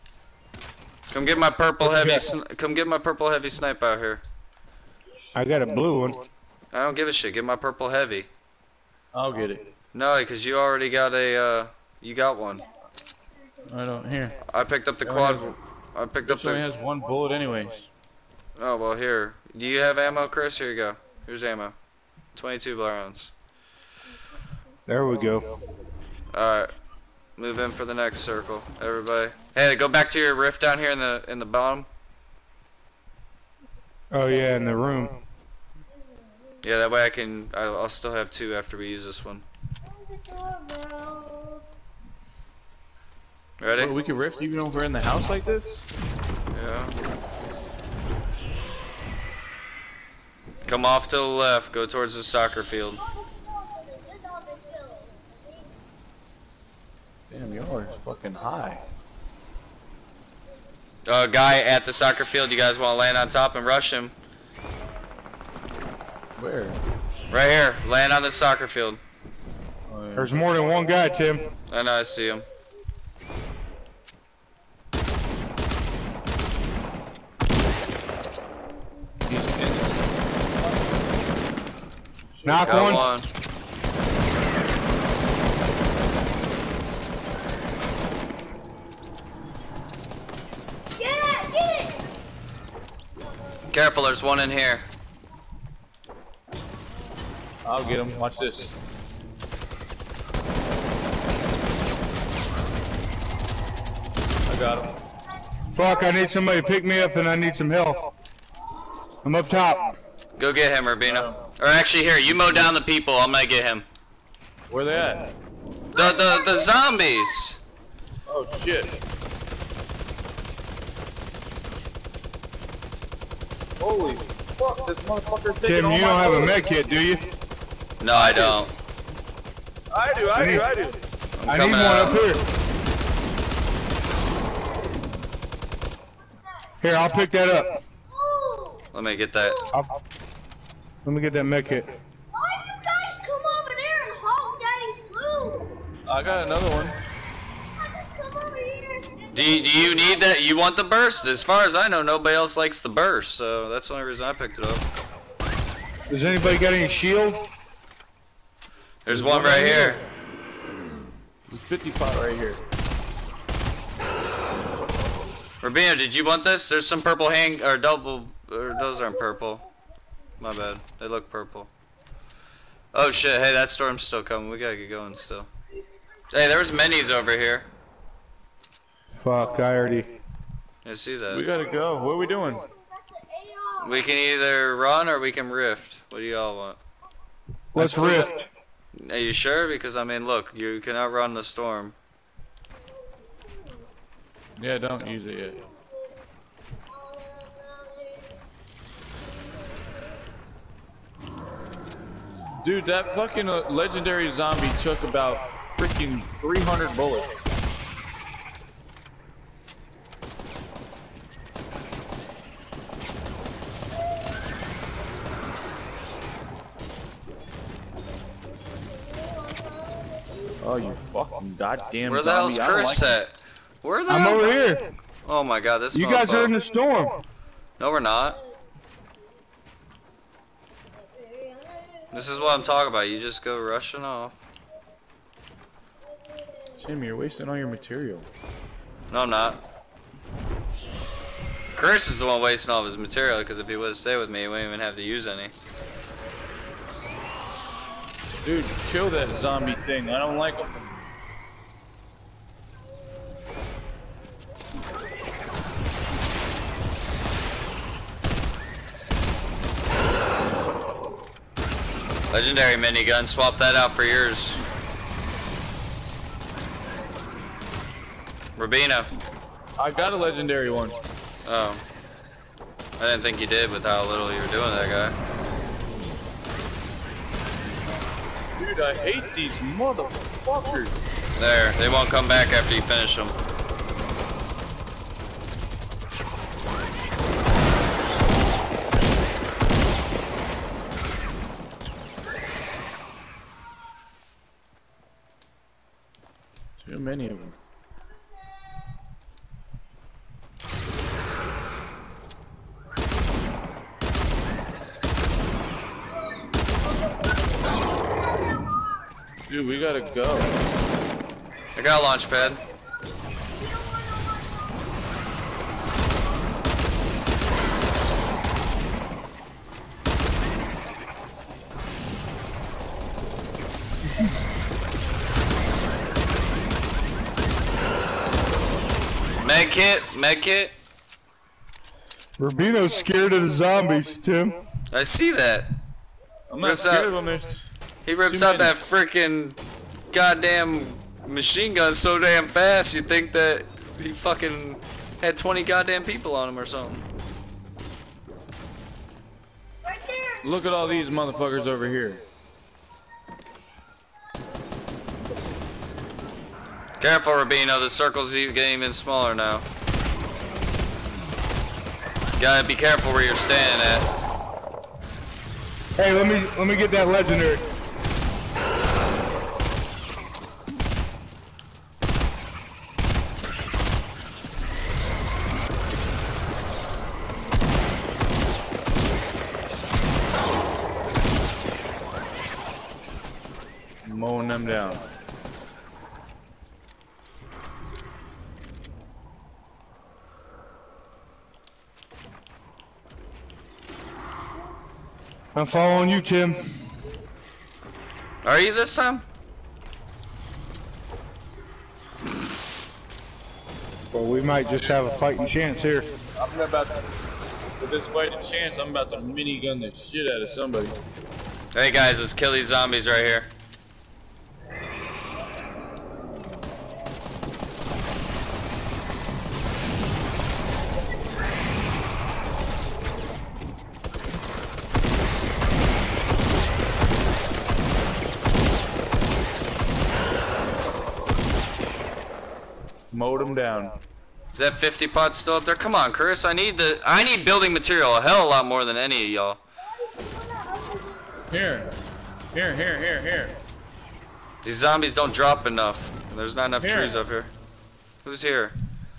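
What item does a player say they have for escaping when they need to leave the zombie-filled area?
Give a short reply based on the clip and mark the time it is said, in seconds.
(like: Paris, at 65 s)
launch pad, at 312 s.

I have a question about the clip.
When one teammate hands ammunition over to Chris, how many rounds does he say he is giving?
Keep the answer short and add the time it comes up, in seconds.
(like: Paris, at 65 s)
22, at 22 s.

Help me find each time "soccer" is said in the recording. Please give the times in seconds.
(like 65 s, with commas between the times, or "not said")
52 s, 61 s, 68 s.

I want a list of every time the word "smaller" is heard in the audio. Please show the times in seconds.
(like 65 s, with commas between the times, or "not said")
358 s.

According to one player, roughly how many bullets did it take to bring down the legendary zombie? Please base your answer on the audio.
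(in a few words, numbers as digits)
300.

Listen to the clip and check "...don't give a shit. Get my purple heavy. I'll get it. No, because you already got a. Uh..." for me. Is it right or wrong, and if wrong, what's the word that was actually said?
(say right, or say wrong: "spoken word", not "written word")
right.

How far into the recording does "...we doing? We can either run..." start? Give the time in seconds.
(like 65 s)
182 s.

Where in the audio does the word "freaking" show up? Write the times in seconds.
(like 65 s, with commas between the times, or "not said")
205 s, 338 s.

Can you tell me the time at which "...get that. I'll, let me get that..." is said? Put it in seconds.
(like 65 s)
139 s.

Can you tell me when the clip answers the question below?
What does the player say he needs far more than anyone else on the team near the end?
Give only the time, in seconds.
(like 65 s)
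437 s.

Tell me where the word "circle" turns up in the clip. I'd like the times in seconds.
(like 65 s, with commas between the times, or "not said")
28 s, 357 s.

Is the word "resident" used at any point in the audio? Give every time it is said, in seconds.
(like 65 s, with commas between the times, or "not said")
not said.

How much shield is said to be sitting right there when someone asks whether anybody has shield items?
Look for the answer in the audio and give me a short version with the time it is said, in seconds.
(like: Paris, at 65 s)
55, at 161 s.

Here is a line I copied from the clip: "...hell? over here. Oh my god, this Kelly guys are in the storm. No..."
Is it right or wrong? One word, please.
wrong.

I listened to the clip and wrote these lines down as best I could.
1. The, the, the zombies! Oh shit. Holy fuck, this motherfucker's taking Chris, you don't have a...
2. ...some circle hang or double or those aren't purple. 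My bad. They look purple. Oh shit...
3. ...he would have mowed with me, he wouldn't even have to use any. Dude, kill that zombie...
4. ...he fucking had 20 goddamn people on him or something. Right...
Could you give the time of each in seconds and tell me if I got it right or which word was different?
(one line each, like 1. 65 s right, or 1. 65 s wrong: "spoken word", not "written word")
1. 115 s wrong: "Tim", not "Chris"
2. 166 s wrong: "purple", not "circle"
3. 243 s wrong: "stayed", not "mowed"
4. 344 s right.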